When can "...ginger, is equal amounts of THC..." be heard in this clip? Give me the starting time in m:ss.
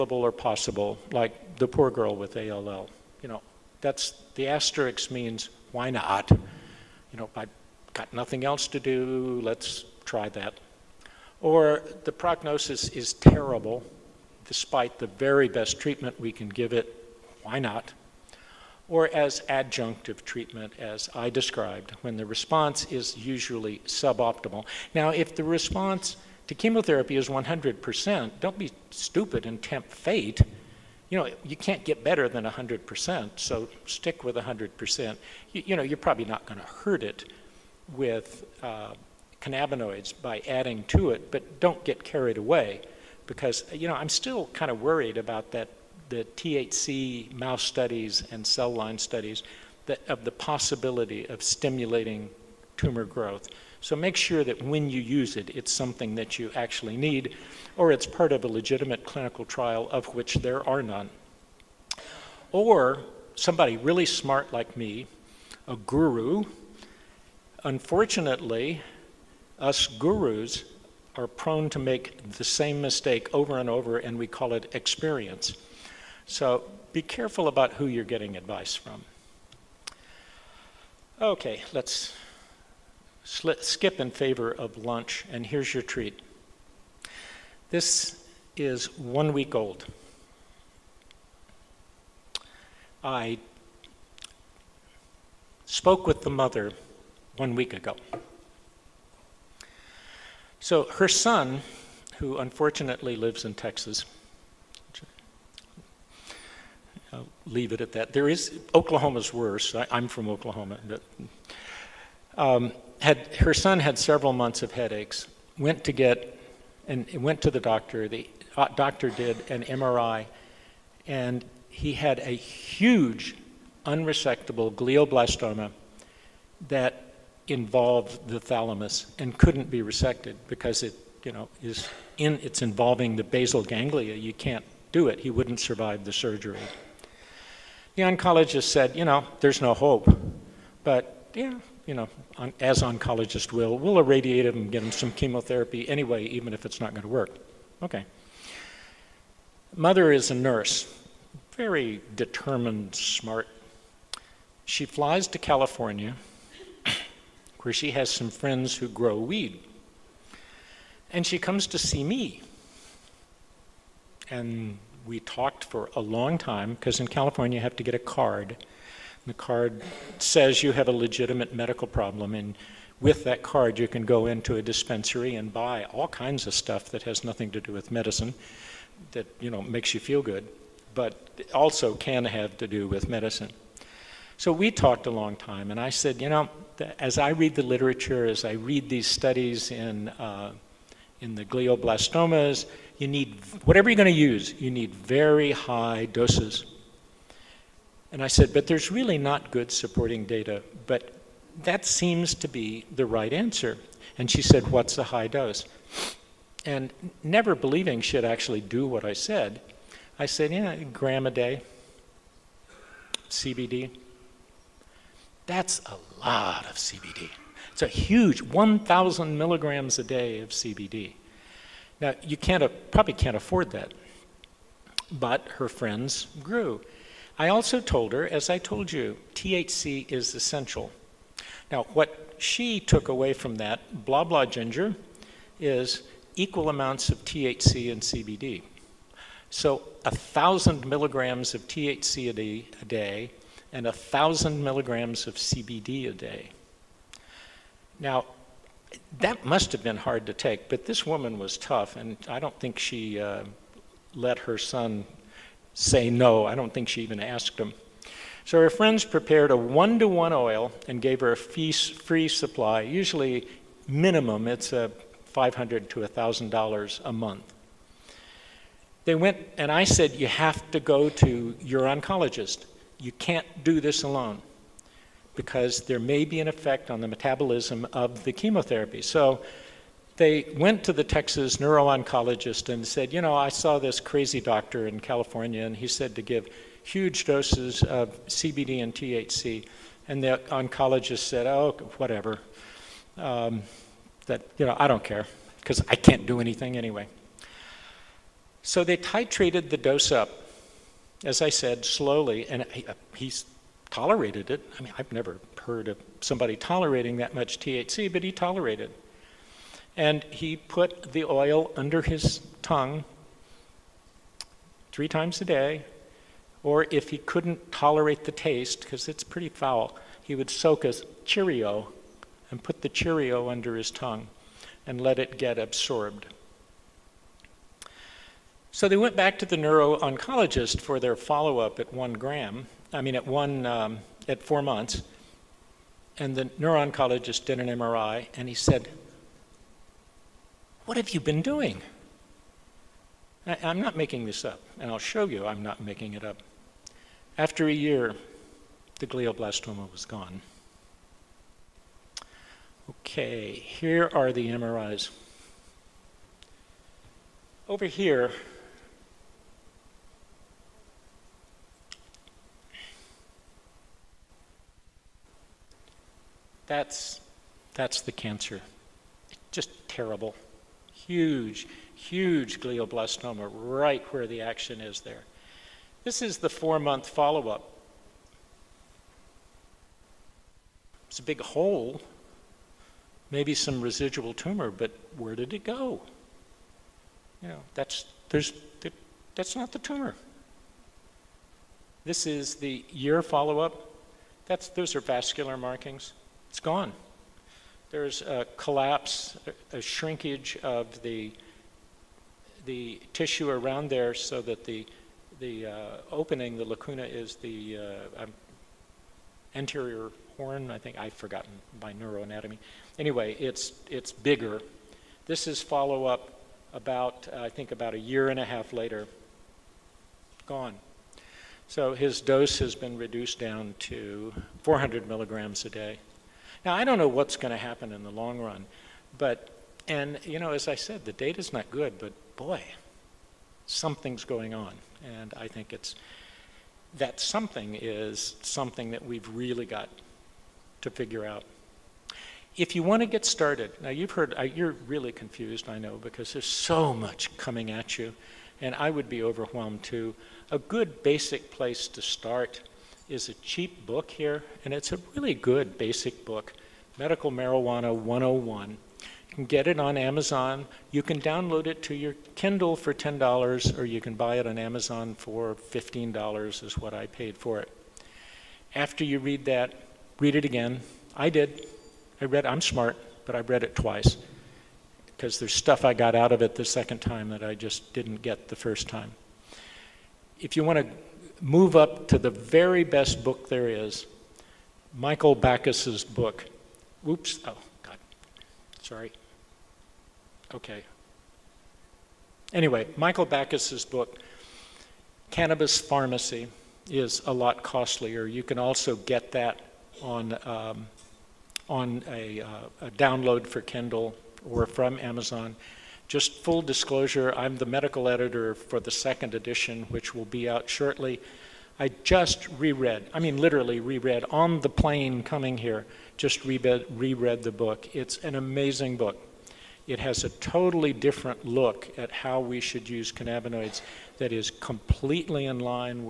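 3:54.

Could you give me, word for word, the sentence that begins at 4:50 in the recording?
And the oncologist said, oh, whatever.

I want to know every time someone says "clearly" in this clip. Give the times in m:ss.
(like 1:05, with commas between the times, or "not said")
not said.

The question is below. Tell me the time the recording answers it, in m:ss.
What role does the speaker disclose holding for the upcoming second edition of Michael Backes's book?
8:27.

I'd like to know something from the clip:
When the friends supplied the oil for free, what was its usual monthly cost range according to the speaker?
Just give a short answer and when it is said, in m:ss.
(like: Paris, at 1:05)
$500 to $1,000, at 4:25.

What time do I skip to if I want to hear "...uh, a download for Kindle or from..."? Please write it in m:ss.
8:22.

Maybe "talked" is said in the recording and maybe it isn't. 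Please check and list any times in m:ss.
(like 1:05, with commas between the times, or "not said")
2:45, 3:04.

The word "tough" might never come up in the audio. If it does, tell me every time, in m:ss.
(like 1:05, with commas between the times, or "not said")
4:11.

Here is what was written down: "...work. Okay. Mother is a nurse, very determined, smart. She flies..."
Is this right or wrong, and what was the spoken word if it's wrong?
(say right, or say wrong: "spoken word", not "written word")
right.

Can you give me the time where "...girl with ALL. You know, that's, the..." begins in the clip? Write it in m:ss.
0:01.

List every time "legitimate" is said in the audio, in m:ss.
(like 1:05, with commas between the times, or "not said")
0:58, 2:50.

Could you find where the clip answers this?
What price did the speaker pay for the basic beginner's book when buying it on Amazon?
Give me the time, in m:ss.
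7:45.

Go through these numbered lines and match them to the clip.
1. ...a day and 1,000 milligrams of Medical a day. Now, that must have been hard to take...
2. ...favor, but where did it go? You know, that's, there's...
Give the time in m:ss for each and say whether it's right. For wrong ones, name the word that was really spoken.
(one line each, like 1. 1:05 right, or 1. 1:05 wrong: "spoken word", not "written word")
1. 4:02 wrong: "CBD", not "Medical"
2. 6:24 wrong: "tumor", not "favor".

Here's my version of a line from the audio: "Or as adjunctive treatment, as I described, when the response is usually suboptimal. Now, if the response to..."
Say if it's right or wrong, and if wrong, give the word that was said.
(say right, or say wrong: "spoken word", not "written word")
right.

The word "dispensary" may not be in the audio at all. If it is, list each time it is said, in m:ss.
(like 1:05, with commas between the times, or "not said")
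2:54.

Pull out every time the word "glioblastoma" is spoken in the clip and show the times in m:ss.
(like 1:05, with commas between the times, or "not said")
2:04, 3:11, 5:49, 6:12.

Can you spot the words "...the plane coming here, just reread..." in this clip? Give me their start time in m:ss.
8:34.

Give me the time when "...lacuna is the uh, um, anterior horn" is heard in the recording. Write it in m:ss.
6:46.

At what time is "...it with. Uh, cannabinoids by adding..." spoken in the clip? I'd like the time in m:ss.
0:37.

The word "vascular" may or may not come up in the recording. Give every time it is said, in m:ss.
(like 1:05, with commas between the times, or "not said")
6:35.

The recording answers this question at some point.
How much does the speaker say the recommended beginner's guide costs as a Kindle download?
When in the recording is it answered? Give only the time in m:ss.
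7:42.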